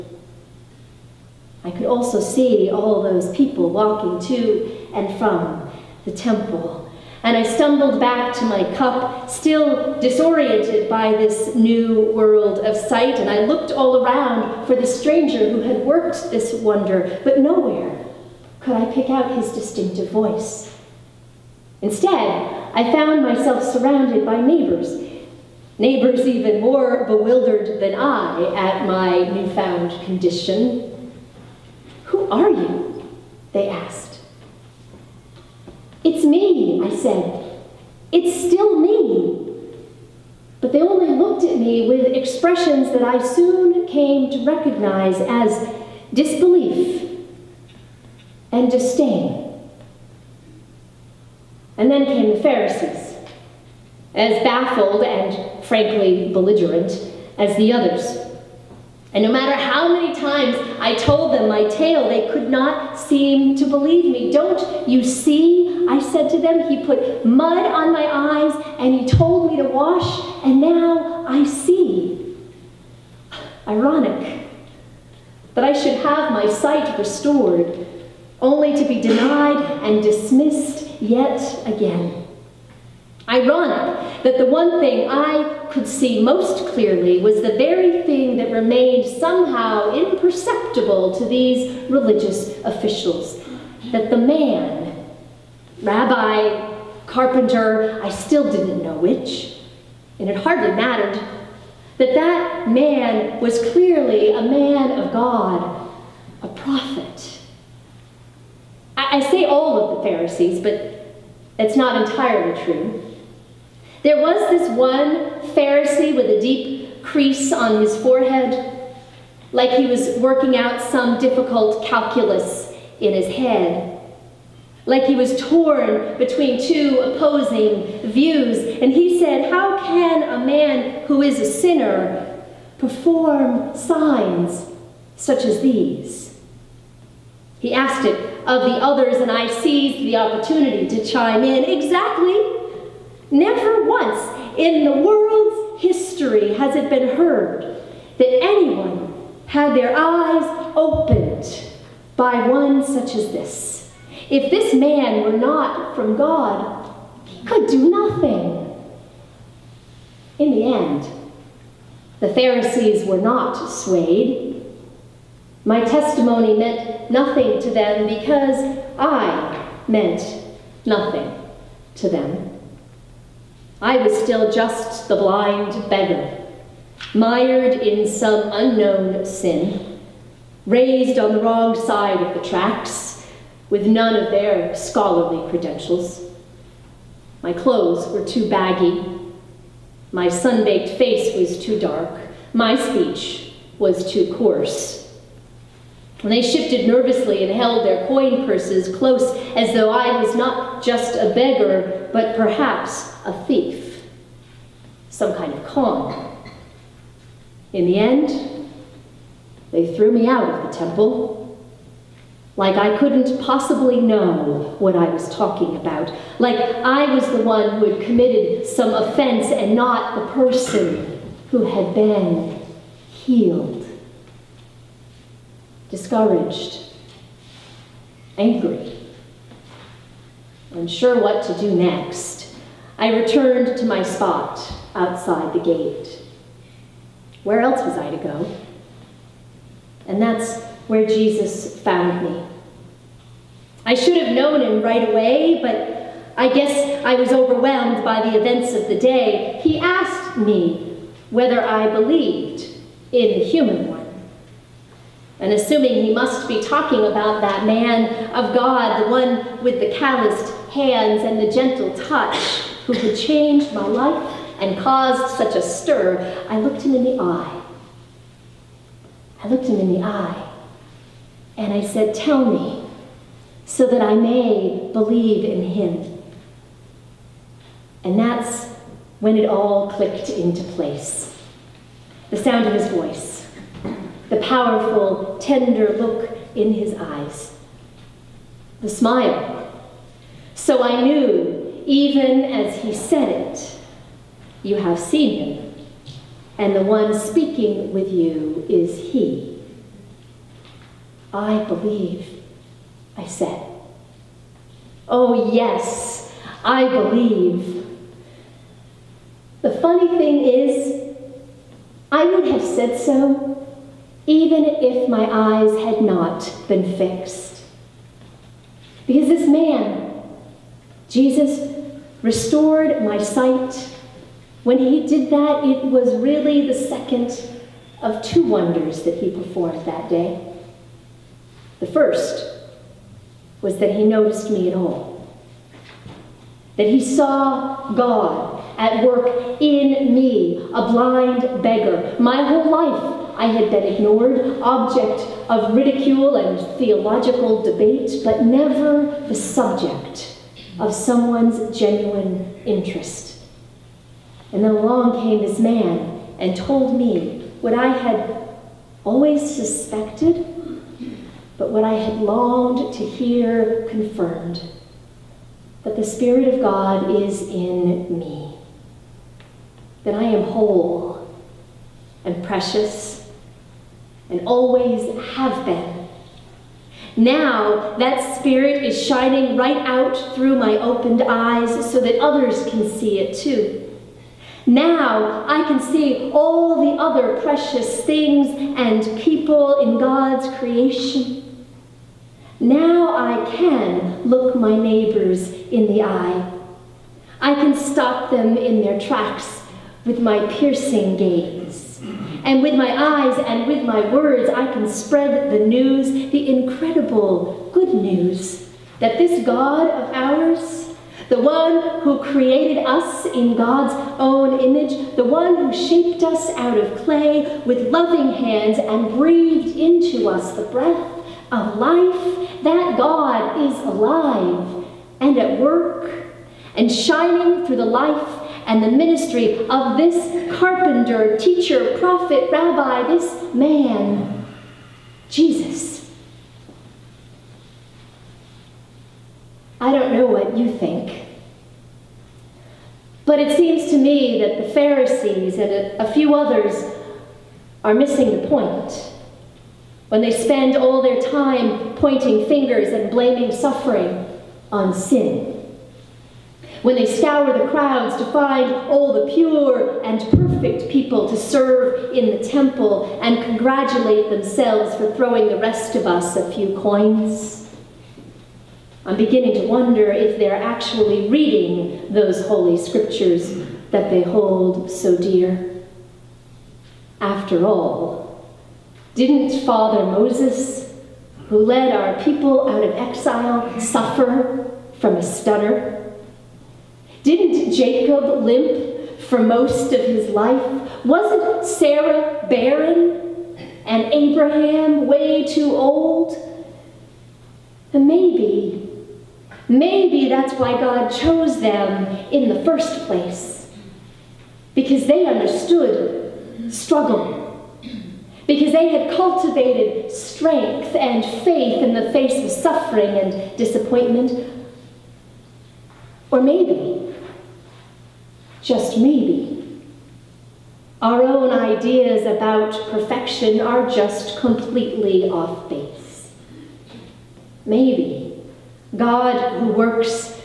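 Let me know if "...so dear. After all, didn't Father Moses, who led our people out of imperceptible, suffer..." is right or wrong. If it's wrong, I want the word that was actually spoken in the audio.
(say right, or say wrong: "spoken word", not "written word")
wrong: "exile", not "imperceptible".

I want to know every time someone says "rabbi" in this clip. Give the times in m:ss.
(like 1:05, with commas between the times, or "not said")
1:35, 7:12.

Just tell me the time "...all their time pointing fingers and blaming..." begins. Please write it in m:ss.
7:30.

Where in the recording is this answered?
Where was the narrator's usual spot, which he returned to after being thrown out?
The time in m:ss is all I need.
3:54.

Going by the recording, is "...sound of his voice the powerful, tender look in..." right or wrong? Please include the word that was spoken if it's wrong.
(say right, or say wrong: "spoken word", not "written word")
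right.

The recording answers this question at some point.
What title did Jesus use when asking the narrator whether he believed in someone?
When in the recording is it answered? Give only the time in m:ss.
4:13.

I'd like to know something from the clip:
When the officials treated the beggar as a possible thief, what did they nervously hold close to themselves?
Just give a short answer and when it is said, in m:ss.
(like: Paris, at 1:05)
their coin purses, at 3:18.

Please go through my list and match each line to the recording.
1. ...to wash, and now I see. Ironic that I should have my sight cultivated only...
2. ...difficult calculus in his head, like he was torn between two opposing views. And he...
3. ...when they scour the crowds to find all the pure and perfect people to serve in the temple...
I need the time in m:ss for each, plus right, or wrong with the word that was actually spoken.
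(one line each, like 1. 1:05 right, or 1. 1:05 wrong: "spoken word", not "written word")
1. 1:09 wrong: "restored", not "cultivated"
2. 2:01 right
3. 7:36 right.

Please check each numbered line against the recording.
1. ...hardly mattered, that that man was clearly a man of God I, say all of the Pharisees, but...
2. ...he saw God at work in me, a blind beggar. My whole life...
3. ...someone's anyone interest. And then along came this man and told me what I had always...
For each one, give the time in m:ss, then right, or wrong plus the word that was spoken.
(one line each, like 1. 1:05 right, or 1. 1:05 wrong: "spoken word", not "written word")
1. 1:40 right
2. 5:36 right
3. 5:50 wrong: "genuine", not "anyone".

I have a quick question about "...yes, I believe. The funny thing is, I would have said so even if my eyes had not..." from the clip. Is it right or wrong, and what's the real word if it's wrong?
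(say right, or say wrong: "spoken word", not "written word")
right.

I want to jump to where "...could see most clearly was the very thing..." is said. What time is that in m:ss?
1:25.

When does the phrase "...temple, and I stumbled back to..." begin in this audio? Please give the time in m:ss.
0:06.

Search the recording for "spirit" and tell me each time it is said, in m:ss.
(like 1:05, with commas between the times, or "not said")
6:06, 6:18.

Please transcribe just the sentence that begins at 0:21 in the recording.
Instead, I found myself surrounded by neighbors, neighbors even more bewildered than I at my newfound condition.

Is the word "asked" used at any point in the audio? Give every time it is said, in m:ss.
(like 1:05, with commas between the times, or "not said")
0:33, 2:17, 4:09.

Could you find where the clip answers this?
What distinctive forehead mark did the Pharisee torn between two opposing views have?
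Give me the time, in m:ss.
1:56.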